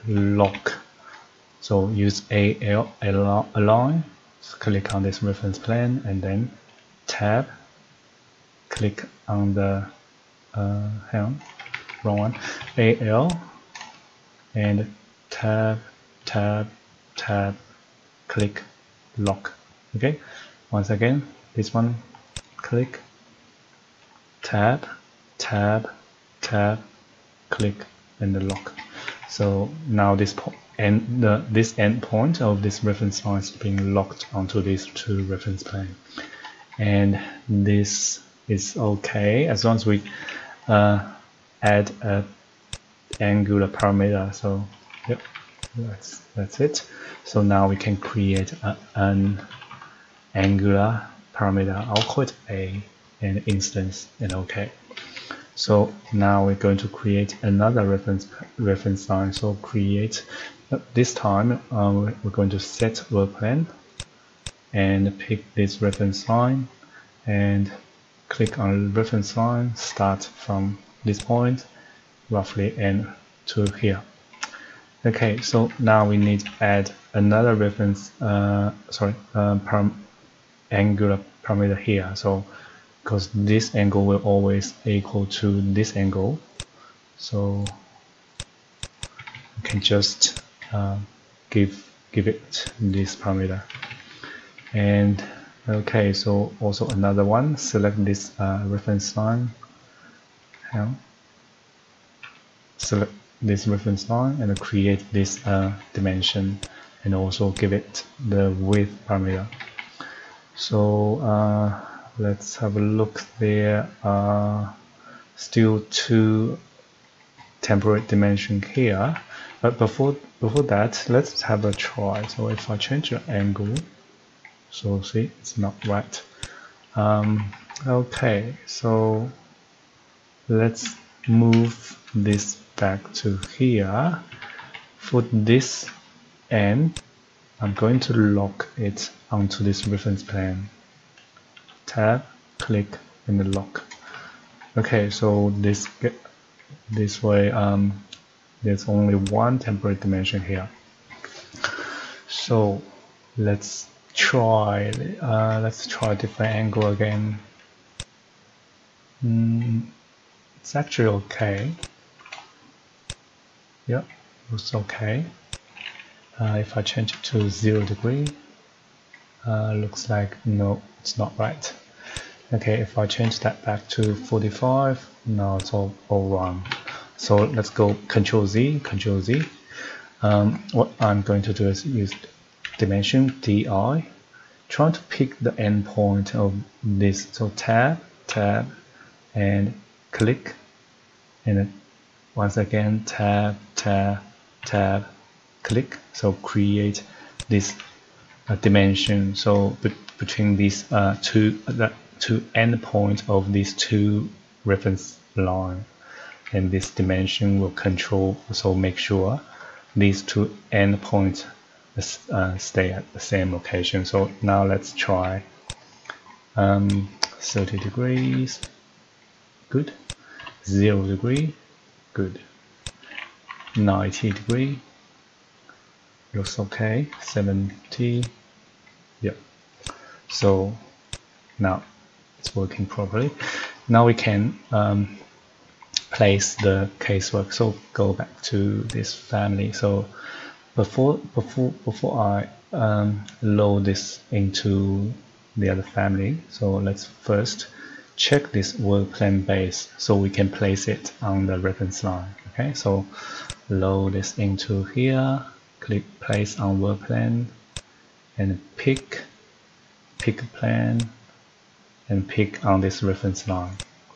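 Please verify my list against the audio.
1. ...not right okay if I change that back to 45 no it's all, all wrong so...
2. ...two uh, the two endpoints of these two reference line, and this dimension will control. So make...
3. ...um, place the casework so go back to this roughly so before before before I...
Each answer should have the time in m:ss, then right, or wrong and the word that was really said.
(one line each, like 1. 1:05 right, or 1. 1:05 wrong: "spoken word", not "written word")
1. 2:51 right
2. 3:21 right
3. 3:54 wrong: "family", not "roughly".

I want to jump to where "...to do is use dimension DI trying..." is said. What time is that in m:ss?
3:01.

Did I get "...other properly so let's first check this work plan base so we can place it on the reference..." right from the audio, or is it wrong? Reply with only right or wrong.
wrong.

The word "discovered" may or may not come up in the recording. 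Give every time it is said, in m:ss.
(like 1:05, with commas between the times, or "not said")
not said.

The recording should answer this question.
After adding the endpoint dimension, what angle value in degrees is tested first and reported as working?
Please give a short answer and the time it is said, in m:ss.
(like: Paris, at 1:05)
30, at 3:37.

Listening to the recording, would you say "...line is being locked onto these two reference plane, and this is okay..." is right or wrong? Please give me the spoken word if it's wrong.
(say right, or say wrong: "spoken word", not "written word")
right.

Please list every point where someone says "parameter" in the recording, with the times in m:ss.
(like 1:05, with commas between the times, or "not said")
0:43, 0:51, 1:21, 1:33, 1:49.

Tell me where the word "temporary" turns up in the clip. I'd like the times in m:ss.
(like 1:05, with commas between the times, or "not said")
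1:57, 2:29.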